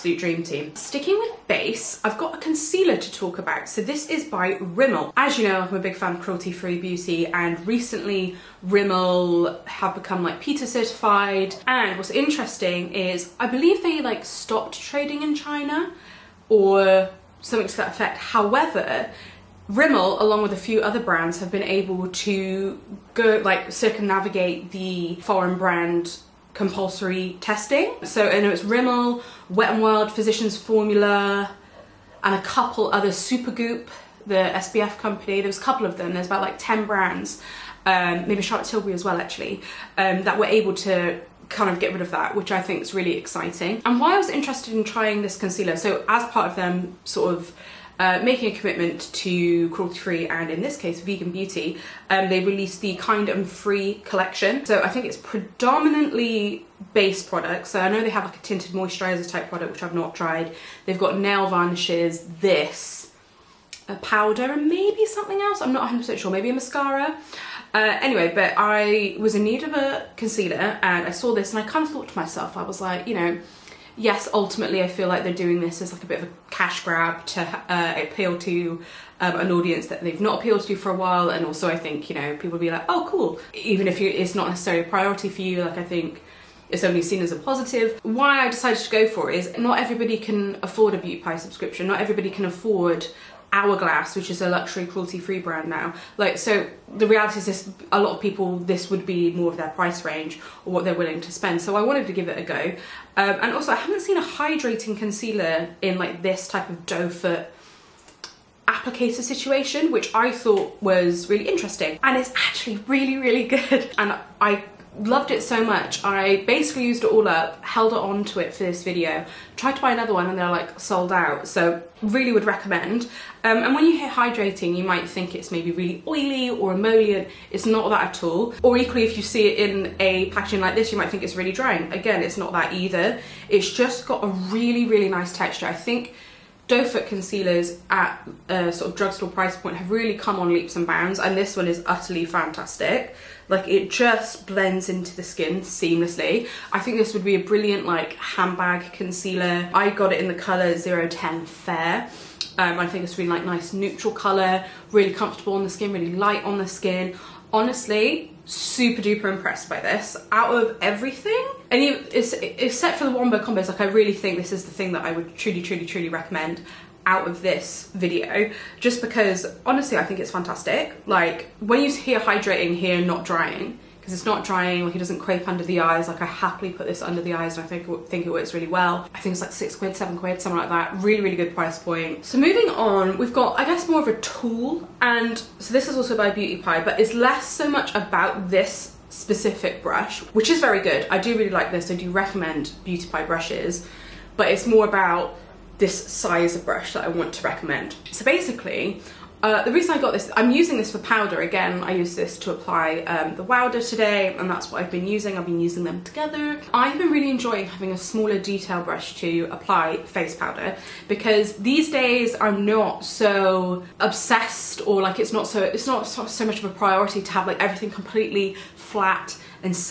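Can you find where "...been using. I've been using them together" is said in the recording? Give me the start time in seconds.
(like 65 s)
204 s.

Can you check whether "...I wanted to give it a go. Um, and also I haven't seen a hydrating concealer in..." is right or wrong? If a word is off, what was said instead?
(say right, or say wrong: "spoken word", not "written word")
right.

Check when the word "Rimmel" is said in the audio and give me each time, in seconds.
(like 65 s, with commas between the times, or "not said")
4 s, 8 s, 19 s, 28 s.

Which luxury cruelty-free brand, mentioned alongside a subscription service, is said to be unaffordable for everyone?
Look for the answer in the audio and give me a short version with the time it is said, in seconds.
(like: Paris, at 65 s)
Hourglass, at 93 s.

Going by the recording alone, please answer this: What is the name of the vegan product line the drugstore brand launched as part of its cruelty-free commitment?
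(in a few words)
Kind and Free.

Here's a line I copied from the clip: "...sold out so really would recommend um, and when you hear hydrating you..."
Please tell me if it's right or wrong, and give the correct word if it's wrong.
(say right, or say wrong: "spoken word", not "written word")
right.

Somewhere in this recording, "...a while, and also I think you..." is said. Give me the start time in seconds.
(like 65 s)
80 s.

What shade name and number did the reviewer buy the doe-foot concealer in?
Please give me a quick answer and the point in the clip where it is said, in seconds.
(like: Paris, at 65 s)
010 Fair, at 150 s.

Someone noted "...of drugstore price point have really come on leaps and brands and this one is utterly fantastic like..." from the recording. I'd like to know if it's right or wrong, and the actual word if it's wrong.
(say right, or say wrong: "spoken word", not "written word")
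wrong: "bounds", not "brands".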